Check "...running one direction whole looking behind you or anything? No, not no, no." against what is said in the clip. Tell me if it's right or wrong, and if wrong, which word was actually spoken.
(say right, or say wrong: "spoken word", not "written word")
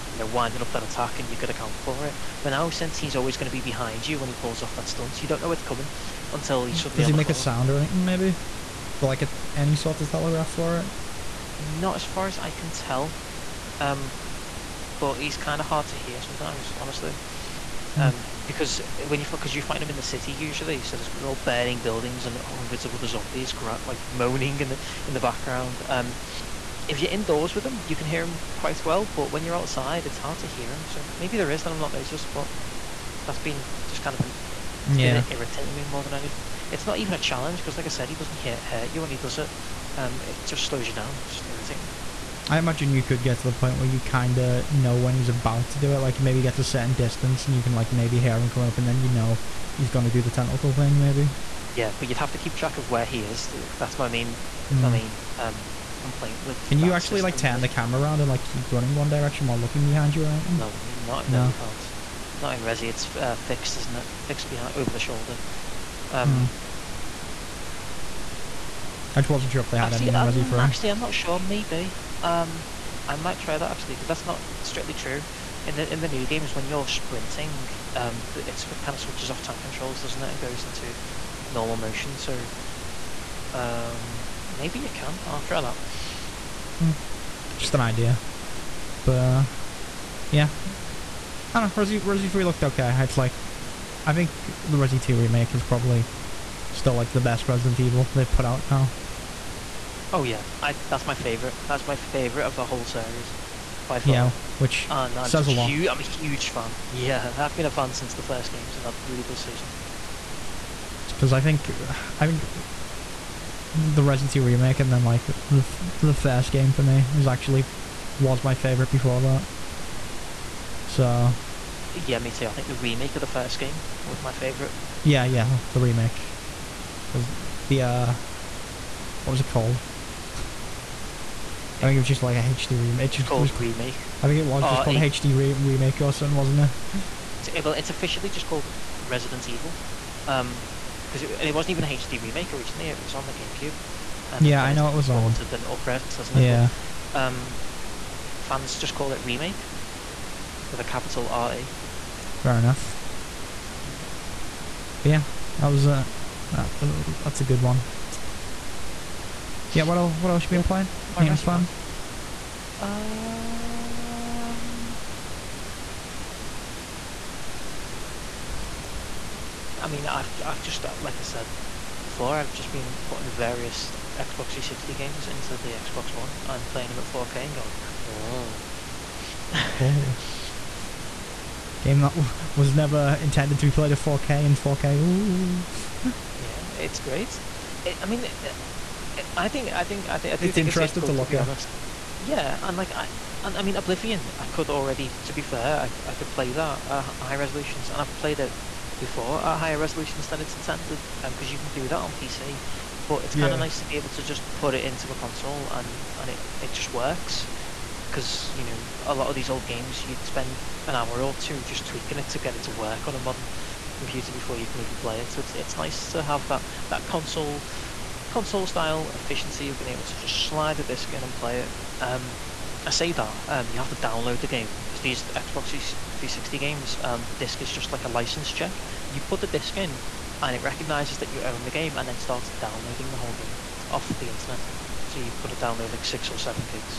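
wrong: "while", not "whole".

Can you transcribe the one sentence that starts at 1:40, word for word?
Oh yeah, I that's my favorite.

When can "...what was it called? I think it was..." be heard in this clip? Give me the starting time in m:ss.
2:09.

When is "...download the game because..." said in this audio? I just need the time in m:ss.
3:43.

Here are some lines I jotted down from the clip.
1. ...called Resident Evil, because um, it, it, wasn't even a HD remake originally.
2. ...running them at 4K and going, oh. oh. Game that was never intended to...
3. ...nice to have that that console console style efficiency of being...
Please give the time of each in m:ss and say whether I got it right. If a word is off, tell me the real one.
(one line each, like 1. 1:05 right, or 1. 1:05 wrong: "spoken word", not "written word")
1. 2:18 right
2. 2:56 wrong: "playing", not "running"
3. 3:35 right.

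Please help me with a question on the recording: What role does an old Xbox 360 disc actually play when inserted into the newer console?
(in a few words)
a license check.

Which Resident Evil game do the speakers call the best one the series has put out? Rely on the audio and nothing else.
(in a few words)
Resident Evil 2 remake.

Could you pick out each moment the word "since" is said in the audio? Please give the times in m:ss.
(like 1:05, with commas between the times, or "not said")
0:02, 1:47.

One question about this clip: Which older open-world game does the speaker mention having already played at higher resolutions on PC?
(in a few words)
Oblivion.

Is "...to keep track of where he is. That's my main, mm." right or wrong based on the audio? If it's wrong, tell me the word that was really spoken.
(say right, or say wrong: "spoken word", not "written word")
right.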